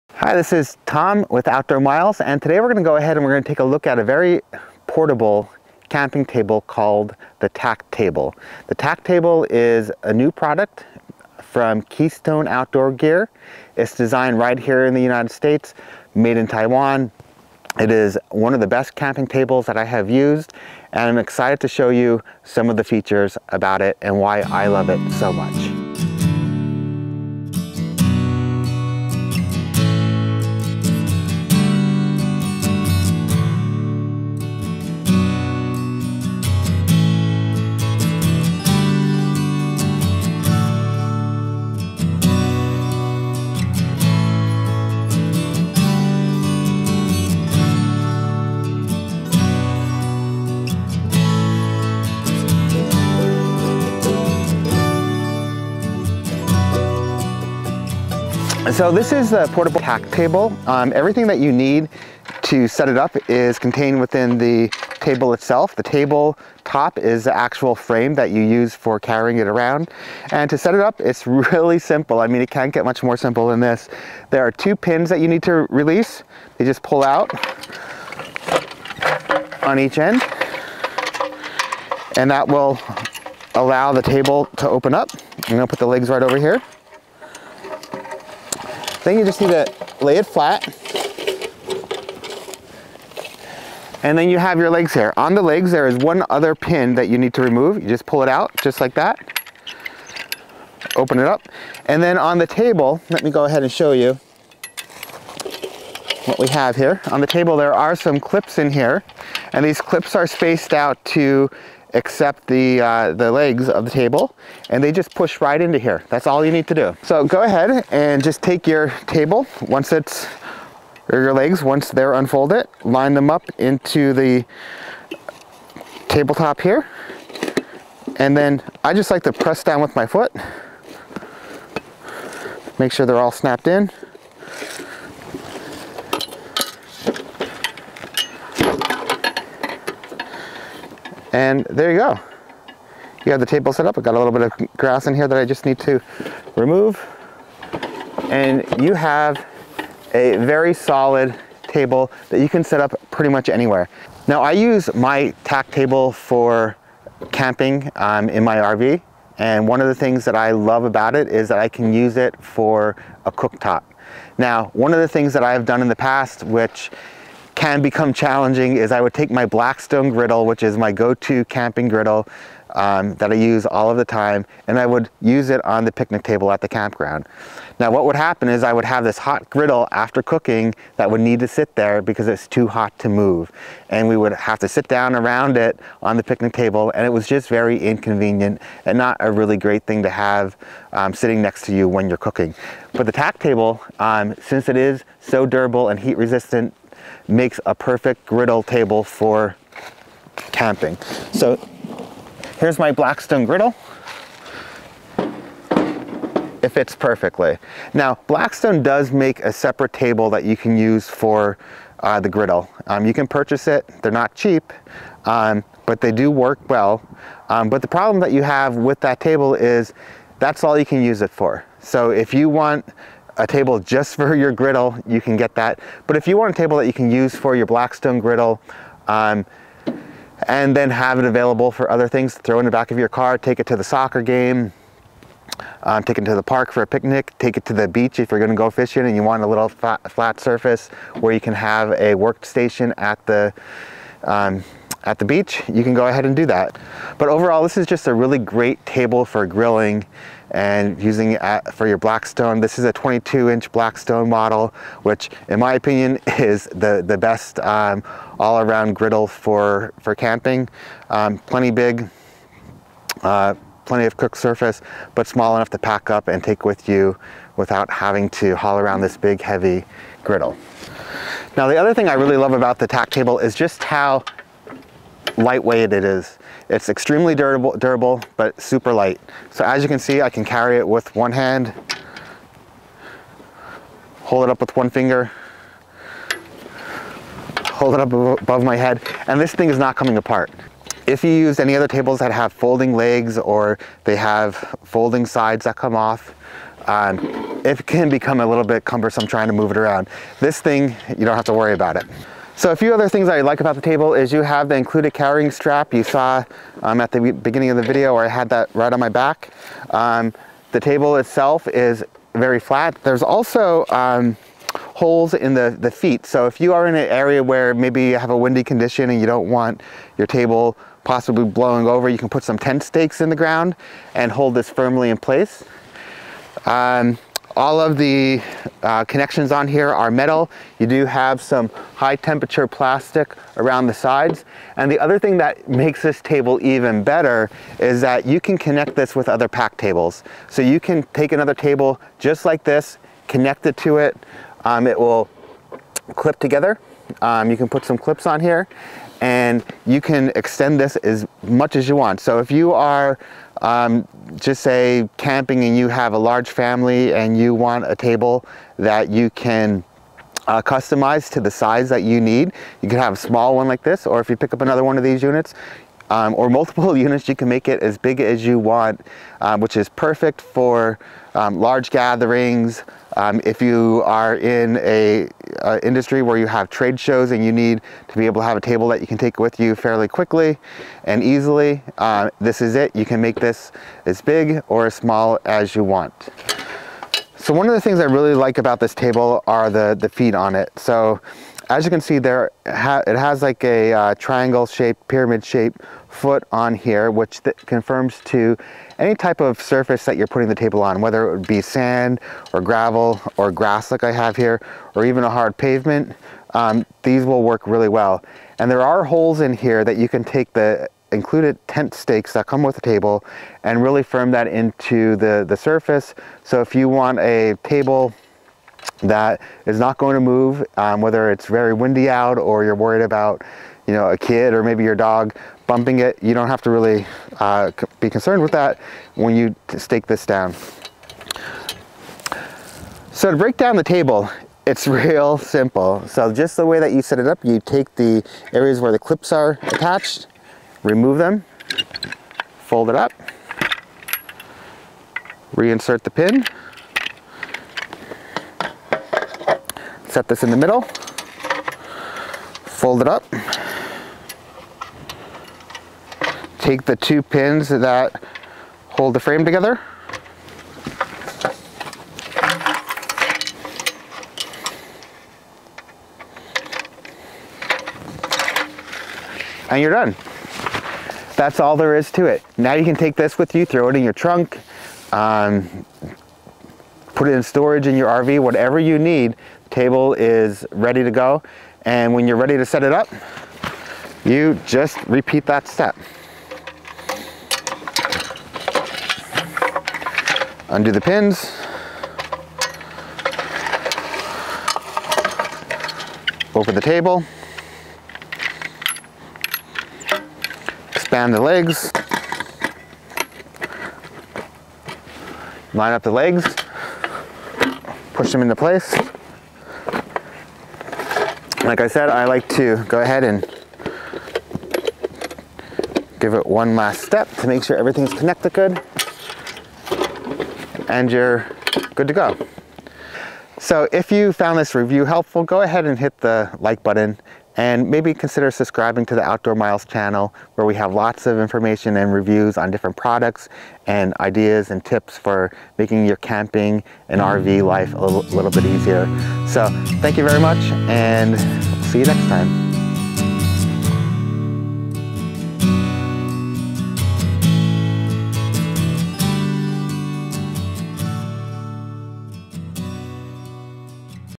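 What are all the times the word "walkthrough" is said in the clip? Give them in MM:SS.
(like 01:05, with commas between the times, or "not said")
not said.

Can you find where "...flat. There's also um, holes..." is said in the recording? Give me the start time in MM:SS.
05:12.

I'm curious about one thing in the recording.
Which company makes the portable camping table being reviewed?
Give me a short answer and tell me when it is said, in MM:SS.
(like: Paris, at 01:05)
Keystone Outdoor Gear, at 00:11.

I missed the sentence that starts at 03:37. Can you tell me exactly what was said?
Um, but the problem that you have with that table is that's all you can use it for.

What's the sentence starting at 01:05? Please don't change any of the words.
The table top is the actual frame that you use for carrying it around.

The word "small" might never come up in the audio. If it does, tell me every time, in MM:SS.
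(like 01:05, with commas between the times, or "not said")
04:25, 06:03, 06:24.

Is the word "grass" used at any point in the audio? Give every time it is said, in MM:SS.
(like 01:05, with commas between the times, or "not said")
02:24, 06:43.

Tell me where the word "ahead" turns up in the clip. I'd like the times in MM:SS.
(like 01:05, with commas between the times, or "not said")
00:02, 01:43, 01:57, 04:06, 08:33, 08:45.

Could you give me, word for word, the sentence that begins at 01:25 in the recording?
I'm gonna put the legs right over here.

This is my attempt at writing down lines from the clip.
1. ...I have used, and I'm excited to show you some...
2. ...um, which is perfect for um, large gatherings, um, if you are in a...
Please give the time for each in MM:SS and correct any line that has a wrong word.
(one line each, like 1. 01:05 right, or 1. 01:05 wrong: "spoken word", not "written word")
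1. 00:19 right
2. 06:09 right.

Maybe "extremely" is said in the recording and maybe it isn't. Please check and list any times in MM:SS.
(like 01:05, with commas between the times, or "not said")
04:36.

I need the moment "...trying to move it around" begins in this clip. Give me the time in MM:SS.
04:59.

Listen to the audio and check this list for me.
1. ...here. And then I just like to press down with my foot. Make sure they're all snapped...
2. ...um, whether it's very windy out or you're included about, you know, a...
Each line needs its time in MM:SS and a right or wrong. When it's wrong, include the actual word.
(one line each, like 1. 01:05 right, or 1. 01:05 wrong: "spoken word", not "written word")
1. 02:06 right
2. 07:00 wrong: "worried", not "included".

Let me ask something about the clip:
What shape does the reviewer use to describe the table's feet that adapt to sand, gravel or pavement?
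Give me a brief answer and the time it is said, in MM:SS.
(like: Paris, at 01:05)
pyramid shaped, at 06:35.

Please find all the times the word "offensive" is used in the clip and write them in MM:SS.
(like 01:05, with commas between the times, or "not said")
not said.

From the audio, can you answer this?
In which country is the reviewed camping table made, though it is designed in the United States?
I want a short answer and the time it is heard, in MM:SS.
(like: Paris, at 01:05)
Taiwan, at 00:16.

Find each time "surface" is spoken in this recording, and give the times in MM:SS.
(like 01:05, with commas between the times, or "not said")
04:00, 04:24, 06:39, 06:55.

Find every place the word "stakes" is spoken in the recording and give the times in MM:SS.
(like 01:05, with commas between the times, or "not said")
05:22, 06:51, 07:09.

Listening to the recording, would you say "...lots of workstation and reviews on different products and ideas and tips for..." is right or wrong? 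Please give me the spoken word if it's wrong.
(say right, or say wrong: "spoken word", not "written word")
wrong: "information", not "workstation".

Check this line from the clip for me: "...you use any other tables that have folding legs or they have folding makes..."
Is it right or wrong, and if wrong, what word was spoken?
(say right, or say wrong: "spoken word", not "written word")
wrong: "sides", not "makes".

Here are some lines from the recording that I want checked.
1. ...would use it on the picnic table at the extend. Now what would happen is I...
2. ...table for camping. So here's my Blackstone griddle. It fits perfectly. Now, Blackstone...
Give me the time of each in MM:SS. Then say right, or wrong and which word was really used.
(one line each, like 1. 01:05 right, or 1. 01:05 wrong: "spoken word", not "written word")
1. 02:54 wrong: "campground", not "extend"
2. 03:18 right.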